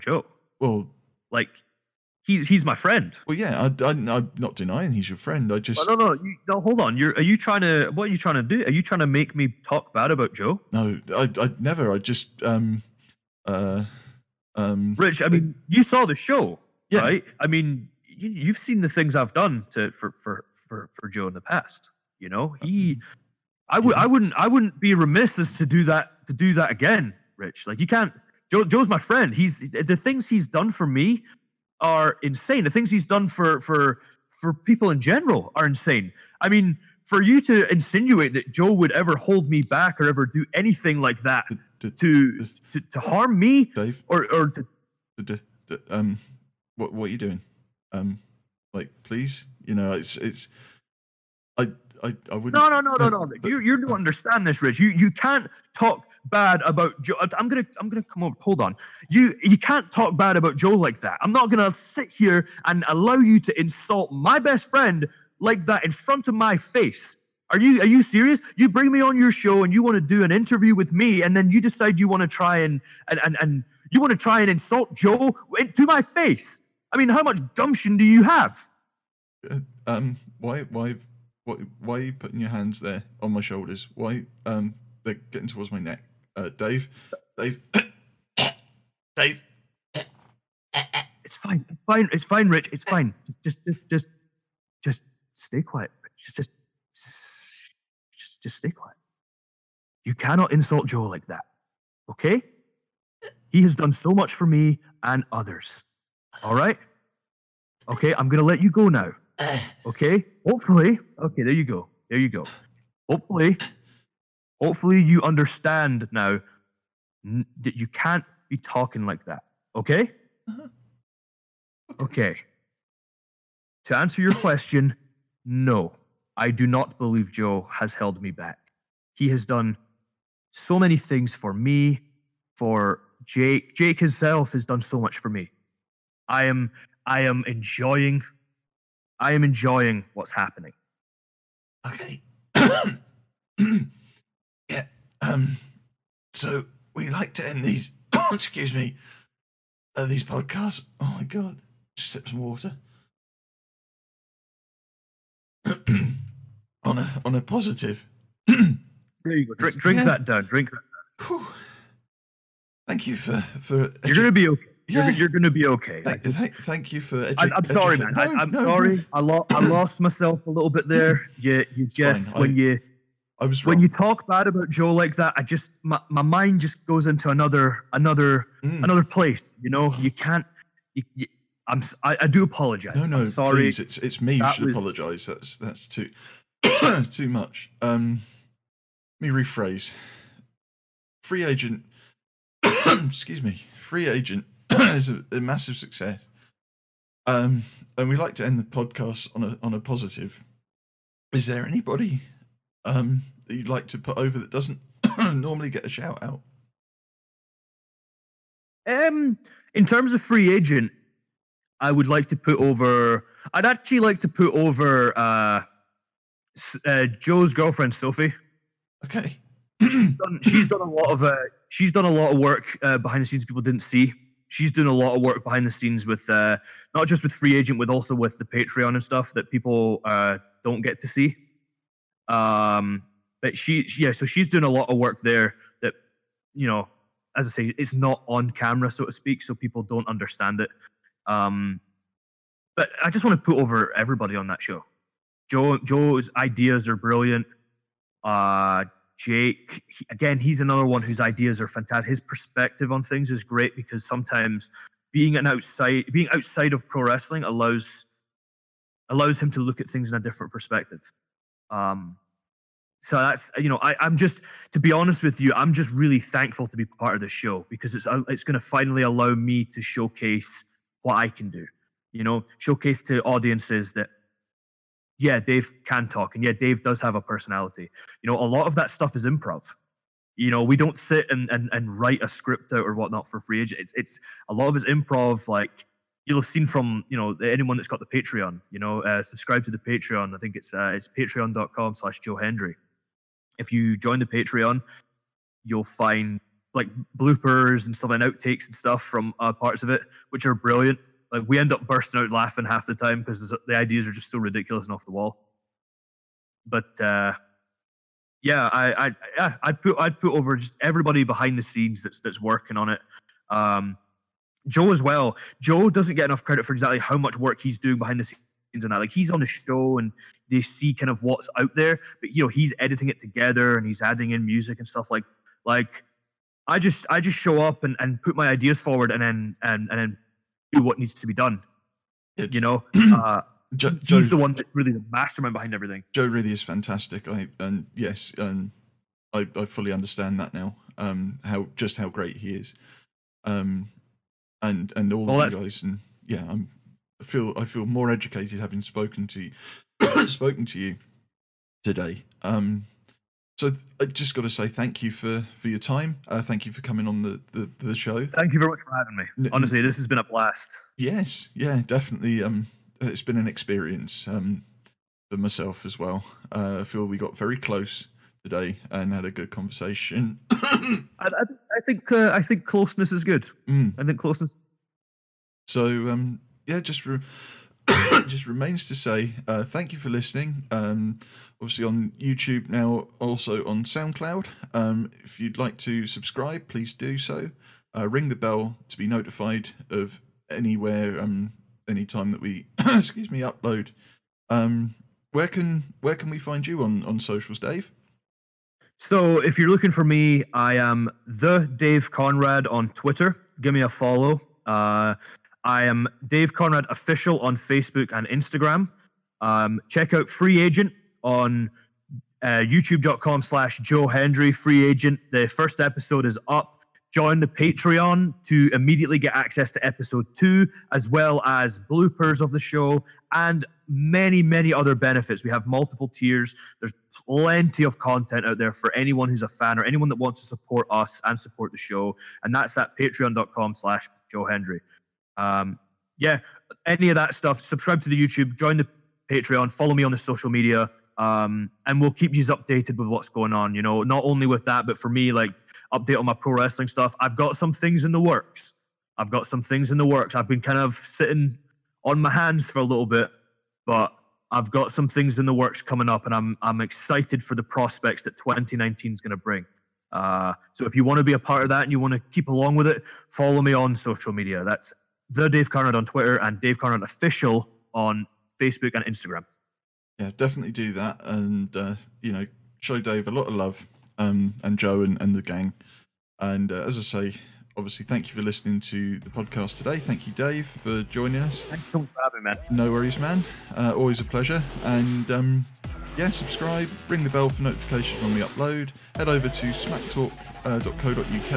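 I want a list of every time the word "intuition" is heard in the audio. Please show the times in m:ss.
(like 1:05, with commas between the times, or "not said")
not said.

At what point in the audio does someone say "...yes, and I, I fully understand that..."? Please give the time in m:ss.
5:37.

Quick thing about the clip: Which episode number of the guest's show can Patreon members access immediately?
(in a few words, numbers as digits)
2.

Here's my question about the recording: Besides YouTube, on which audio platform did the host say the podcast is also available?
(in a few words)
SoundCloud.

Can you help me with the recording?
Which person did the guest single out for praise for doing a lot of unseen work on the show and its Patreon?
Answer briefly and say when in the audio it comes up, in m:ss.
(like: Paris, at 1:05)
Sophie, at 3:37.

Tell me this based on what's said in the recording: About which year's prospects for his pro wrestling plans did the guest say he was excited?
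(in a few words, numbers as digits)
2019.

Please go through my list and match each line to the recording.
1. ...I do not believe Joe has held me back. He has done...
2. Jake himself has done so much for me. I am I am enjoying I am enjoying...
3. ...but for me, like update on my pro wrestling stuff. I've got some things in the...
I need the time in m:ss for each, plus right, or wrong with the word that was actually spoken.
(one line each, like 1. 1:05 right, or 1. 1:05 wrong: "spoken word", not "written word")
1. 2:06 right
2. 2:13 right
3. 7:24 right.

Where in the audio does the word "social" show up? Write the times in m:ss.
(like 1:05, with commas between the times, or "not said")
6:37, 7:20, 7:43.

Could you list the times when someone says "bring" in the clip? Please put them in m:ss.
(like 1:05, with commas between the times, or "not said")
1:08, 7:39.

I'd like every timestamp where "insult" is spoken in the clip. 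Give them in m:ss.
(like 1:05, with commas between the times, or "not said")
1:03, 1:14, 1:40.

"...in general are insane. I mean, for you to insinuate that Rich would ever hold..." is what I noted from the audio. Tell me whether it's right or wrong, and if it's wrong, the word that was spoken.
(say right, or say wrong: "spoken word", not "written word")
wrong: "Joe", not "Rich".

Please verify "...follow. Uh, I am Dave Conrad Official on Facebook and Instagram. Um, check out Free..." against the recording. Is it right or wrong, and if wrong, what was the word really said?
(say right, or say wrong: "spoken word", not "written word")
right.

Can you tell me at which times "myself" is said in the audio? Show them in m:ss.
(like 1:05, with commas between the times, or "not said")
2:50, 6:05.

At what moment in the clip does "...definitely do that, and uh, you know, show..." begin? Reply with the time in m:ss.
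7:50.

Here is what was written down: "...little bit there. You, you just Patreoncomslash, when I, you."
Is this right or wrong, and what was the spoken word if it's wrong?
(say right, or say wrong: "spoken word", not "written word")
wrong: "Fine", not "Patreoncomslash".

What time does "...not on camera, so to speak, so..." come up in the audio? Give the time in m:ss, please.
3:57.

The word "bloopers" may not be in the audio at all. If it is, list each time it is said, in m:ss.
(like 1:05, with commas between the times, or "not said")
4:57, 7:01.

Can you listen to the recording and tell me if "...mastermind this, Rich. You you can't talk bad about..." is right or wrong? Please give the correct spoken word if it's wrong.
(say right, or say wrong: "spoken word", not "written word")
wrong: "understand", not "mastermind".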